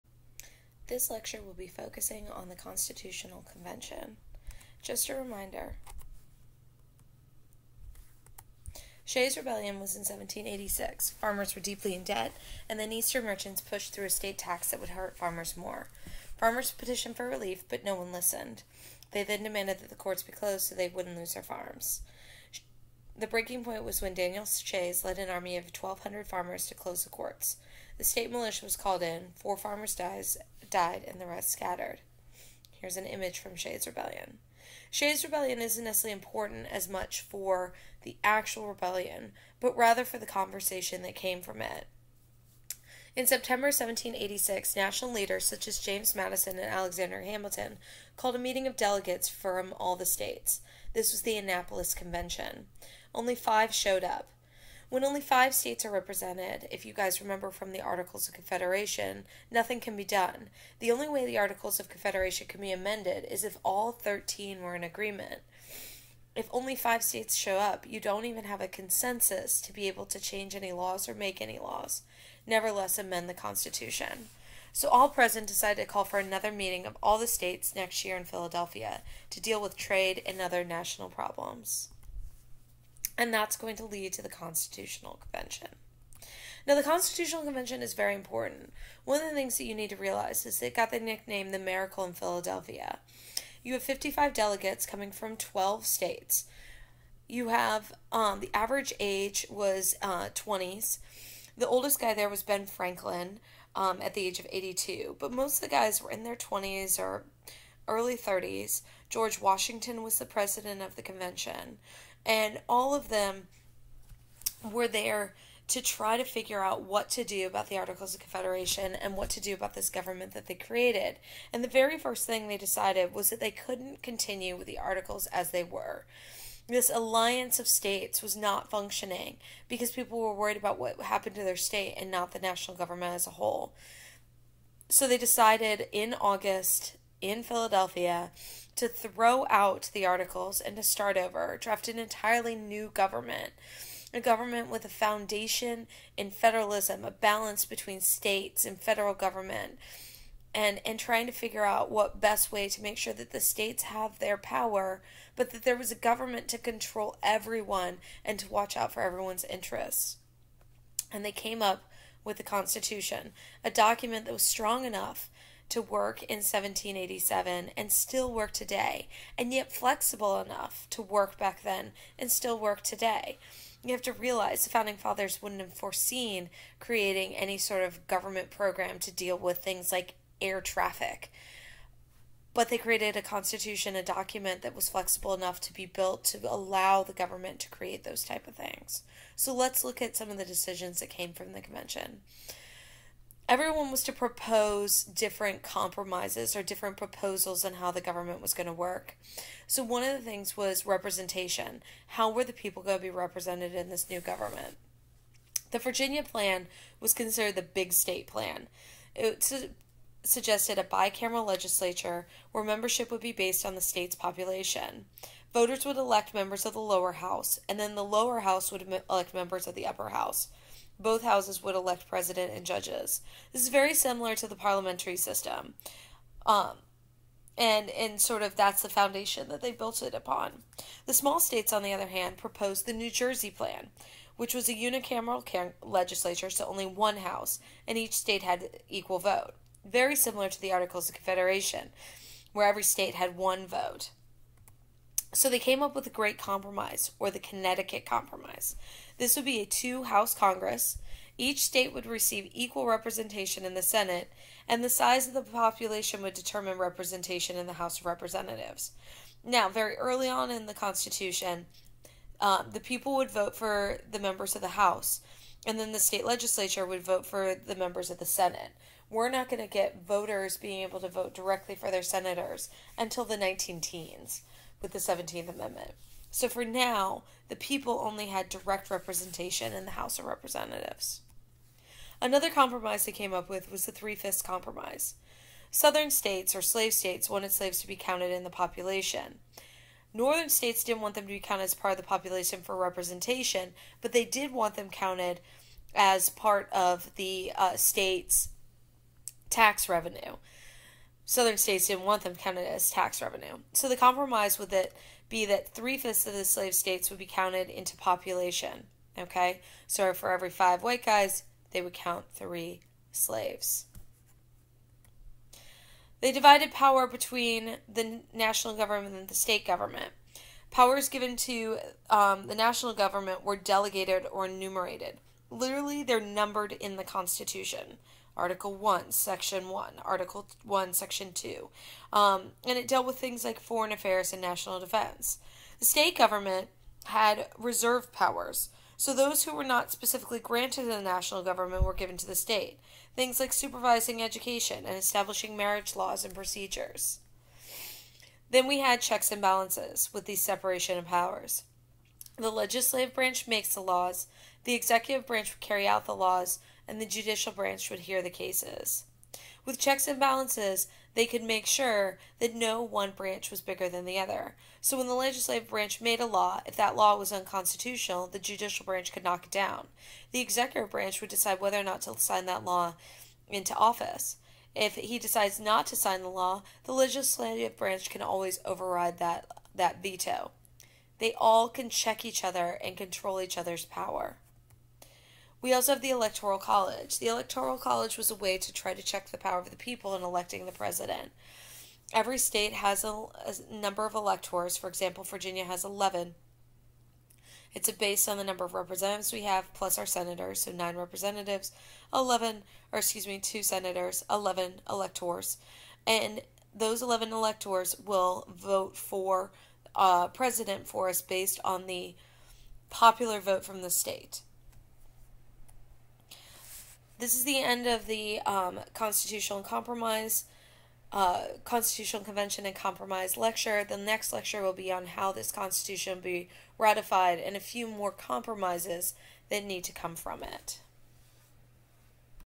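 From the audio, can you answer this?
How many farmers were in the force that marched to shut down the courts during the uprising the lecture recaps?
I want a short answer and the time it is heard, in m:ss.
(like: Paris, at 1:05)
1,200, at 0:25.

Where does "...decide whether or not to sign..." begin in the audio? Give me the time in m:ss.
6:11.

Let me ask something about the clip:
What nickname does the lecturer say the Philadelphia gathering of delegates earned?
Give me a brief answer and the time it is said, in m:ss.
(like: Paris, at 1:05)
the Miracle in Philadelphia, at 1:31.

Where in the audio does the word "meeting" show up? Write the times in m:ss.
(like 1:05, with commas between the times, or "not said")
0:48, 1:16.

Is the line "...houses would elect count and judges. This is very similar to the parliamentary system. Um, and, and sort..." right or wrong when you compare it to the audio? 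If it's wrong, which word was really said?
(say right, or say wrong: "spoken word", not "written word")
wrong: "president", not "count".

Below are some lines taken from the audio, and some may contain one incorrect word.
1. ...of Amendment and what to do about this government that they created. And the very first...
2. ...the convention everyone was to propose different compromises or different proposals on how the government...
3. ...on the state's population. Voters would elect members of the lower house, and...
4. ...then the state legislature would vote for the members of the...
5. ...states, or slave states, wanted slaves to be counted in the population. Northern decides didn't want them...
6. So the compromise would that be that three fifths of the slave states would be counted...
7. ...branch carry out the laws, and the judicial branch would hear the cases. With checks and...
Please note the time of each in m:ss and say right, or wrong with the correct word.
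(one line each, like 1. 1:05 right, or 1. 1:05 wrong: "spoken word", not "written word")
1. 1:58 wrong: "Confederation", not "Amendment"
2. 3:11 right
3. 3:33 right
4. 4:25 right
5. 4:46 wrong: "states", not "decides"
6. 5:03 right
7. 5:55 right.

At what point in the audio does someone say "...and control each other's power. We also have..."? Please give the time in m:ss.
6:22.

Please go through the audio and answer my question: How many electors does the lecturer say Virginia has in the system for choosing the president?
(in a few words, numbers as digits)
11.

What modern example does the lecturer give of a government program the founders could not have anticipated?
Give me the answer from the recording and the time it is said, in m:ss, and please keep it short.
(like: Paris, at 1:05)
air traffic, at 3:00.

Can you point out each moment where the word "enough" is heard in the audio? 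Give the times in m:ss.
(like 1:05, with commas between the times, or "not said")
2:44, 2:50, 3:05.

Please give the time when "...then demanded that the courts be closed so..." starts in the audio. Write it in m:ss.
0:19.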